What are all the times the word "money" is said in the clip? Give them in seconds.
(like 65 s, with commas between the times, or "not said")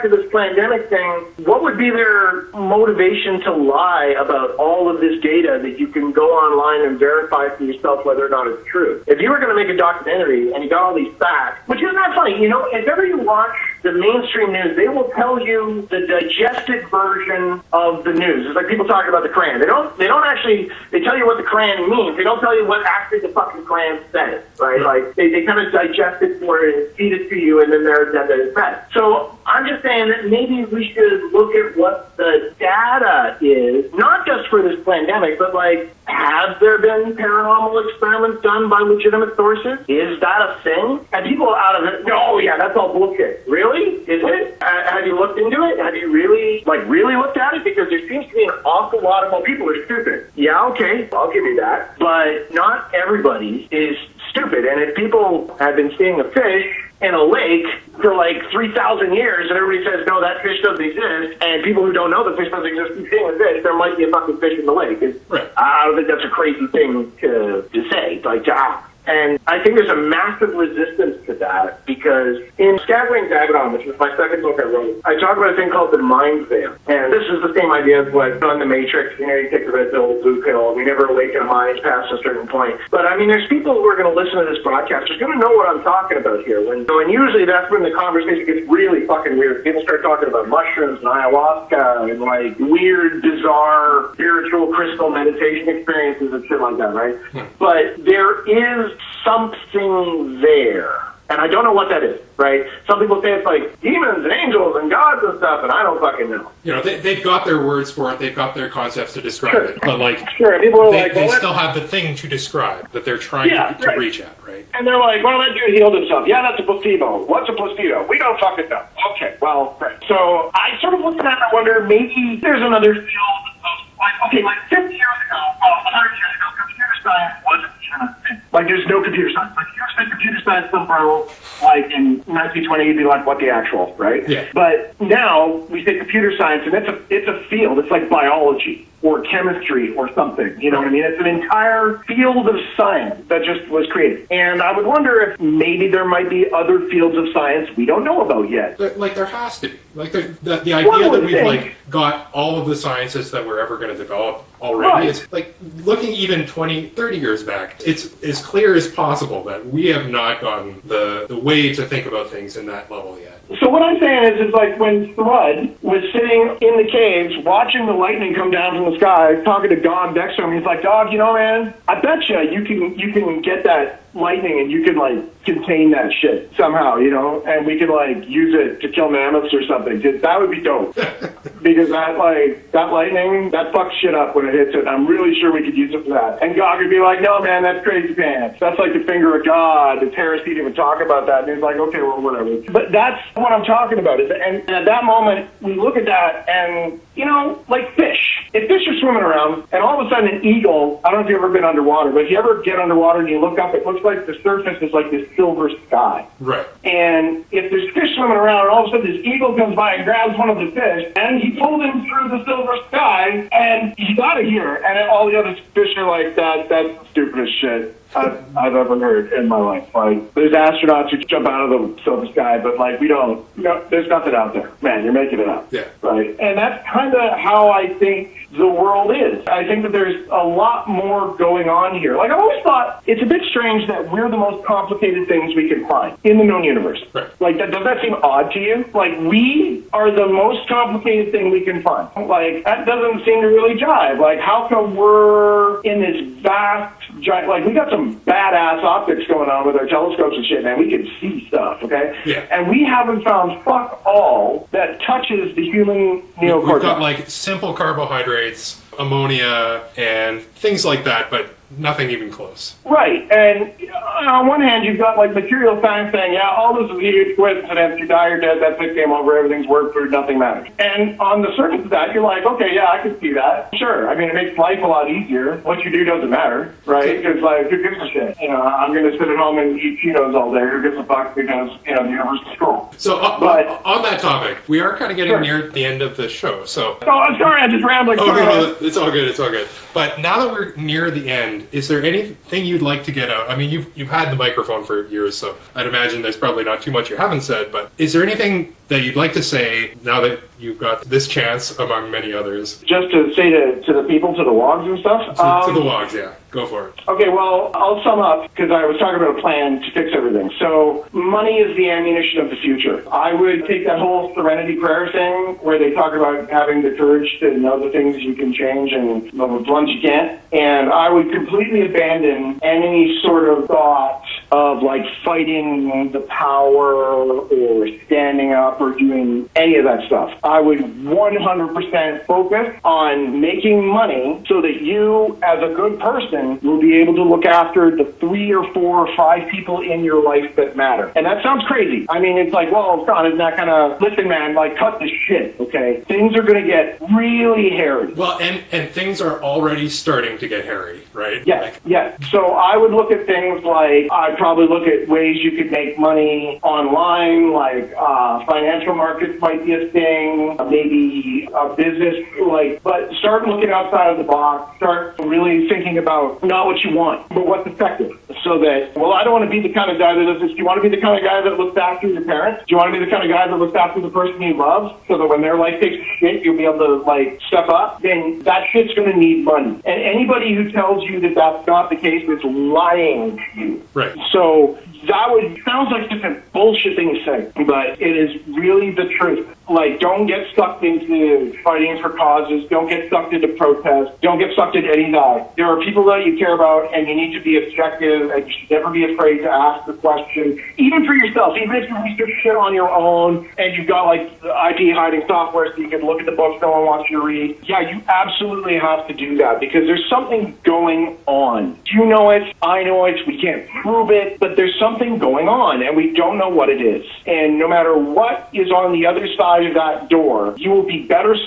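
311 s, 333 s, 355 s, 379 s.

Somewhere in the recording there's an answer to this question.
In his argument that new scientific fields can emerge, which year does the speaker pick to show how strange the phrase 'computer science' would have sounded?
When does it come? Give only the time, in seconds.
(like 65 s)
132 s.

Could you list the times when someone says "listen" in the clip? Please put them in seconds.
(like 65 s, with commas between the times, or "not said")
84 s, 344 s.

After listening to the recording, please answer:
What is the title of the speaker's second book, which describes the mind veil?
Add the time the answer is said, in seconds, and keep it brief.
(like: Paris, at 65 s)
Scattering Dagonon, at 72 s.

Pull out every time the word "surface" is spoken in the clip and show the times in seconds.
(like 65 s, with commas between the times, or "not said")
204 s, 271 s.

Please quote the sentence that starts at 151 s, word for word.
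like got all of the sciences that we're ever going to develop already.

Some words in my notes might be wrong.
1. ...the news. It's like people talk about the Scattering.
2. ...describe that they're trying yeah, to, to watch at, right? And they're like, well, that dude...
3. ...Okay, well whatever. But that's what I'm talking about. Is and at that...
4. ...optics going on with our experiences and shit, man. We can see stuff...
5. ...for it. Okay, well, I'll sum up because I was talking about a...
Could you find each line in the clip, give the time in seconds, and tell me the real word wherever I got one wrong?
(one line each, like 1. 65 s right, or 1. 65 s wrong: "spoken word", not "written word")
1. 18 s wrong: "Koran", not "Scattering"
2. 112 s wrong: "reach", not "watch"
3. 191 s right
4. 248 s wrong: "telescopes", not "experiences"
5. 306 s right.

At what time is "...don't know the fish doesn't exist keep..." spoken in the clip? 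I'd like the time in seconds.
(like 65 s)
61 s.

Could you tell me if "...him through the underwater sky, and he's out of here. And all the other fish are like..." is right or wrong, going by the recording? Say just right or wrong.
wrong.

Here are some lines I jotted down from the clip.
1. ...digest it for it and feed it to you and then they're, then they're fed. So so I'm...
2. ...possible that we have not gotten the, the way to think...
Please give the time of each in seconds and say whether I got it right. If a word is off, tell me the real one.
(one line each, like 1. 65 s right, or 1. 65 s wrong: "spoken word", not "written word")
1. 25 s right
2. 158 s right.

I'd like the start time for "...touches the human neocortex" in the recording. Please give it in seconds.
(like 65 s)
255 s.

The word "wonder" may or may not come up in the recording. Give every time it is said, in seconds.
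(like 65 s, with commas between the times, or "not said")
121 s, 144 s.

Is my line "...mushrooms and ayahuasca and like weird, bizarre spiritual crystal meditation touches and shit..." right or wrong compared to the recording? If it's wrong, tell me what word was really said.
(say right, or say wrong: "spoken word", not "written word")
wrong: "experiences", not "touches".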